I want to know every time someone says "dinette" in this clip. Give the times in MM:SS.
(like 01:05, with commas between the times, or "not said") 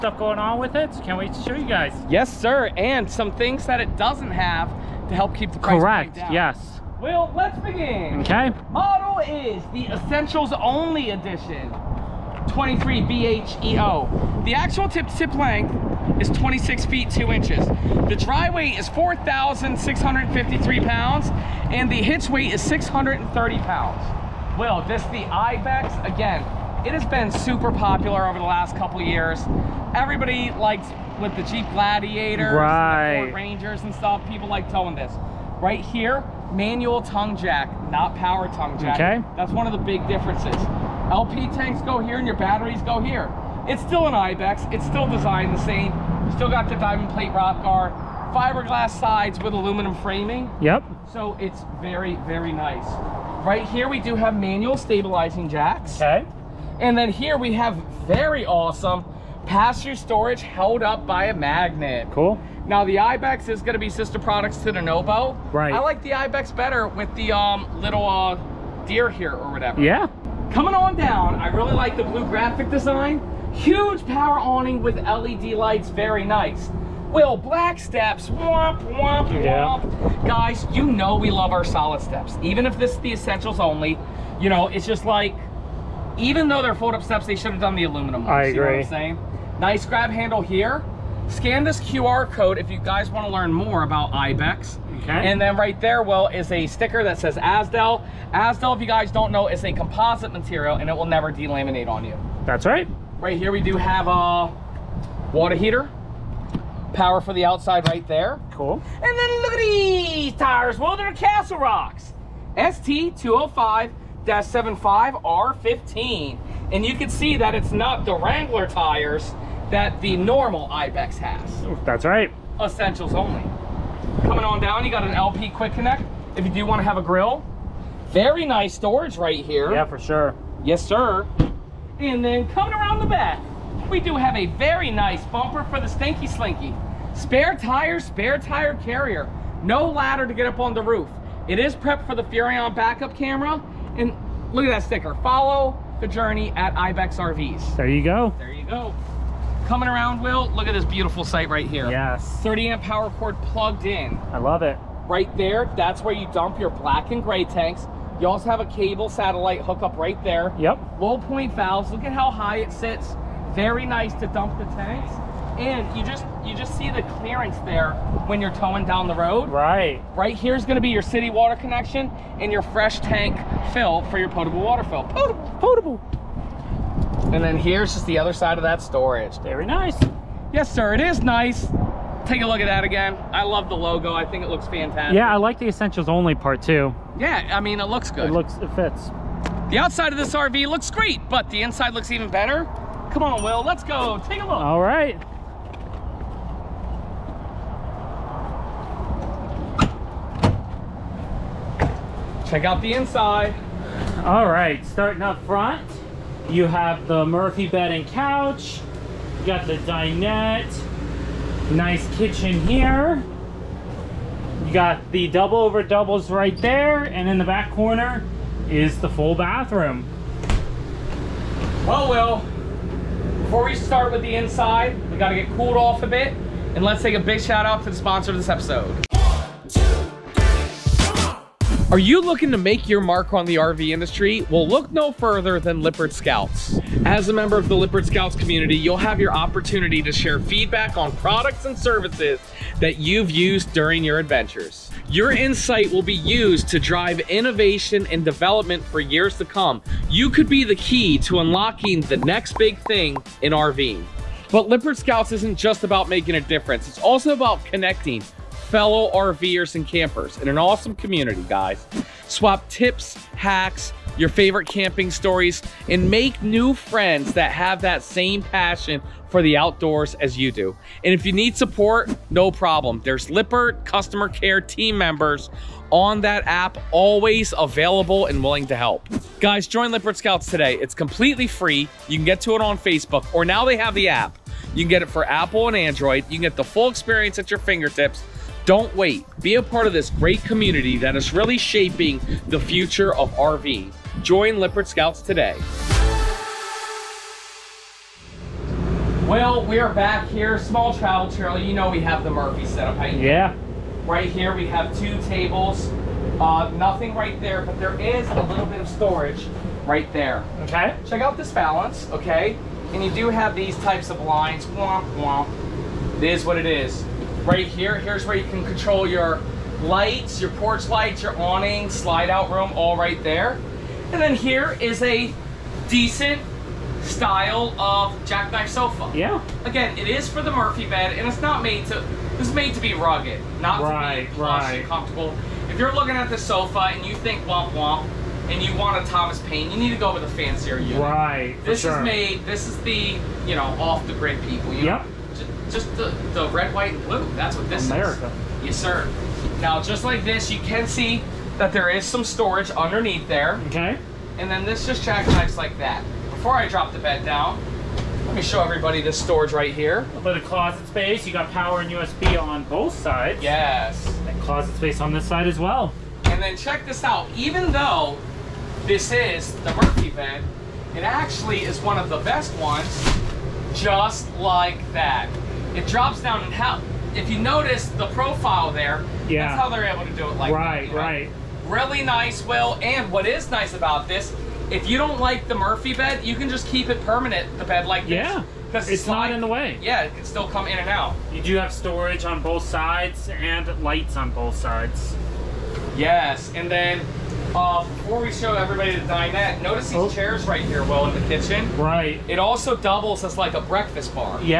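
03:29, 06:39.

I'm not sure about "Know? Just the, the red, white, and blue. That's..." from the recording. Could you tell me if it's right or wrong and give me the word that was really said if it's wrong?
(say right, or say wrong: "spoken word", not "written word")
right.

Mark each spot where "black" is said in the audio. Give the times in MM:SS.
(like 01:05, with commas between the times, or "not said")
01:17, 02:36.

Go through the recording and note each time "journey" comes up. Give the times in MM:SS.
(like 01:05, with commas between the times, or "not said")
02:26.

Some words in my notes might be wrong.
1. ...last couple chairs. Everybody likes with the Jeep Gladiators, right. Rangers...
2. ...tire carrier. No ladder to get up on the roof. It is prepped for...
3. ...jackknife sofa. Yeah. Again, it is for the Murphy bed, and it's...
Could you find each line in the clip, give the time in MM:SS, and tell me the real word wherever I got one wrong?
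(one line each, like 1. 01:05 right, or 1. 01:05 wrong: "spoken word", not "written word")
1. 00:28 wrong: "years", not "chairs"
2. 02:18 right
3. 05:28 right.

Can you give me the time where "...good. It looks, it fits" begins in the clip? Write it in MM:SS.
03:08.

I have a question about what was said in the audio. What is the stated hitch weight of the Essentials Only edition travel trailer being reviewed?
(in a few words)
630 pounds.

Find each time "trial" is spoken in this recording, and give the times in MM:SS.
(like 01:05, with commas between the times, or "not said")
not said.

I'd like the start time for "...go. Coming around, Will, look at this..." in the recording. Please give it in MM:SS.
02:28.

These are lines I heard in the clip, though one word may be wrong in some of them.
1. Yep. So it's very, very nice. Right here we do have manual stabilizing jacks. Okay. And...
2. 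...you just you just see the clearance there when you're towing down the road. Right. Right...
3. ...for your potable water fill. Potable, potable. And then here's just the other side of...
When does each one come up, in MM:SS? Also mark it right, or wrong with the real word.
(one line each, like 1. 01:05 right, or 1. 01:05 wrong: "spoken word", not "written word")
1. 00:50 right
2. 02:45 right
3. 02:54 right.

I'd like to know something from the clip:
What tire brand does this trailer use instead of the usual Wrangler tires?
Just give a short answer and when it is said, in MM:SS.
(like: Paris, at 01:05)
Castle Rocks, at 01:51.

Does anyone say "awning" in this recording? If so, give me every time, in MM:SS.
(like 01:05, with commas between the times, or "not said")
01:14, 05:21.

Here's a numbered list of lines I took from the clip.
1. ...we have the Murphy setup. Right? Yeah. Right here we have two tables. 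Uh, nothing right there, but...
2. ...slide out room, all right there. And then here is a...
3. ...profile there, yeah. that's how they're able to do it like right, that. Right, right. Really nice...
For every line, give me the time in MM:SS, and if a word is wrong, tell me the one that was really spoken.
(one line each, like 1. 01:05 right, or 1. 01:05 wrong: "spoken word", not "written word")
1. 05:01 right
2. 05:21 right
3. 06:18 right.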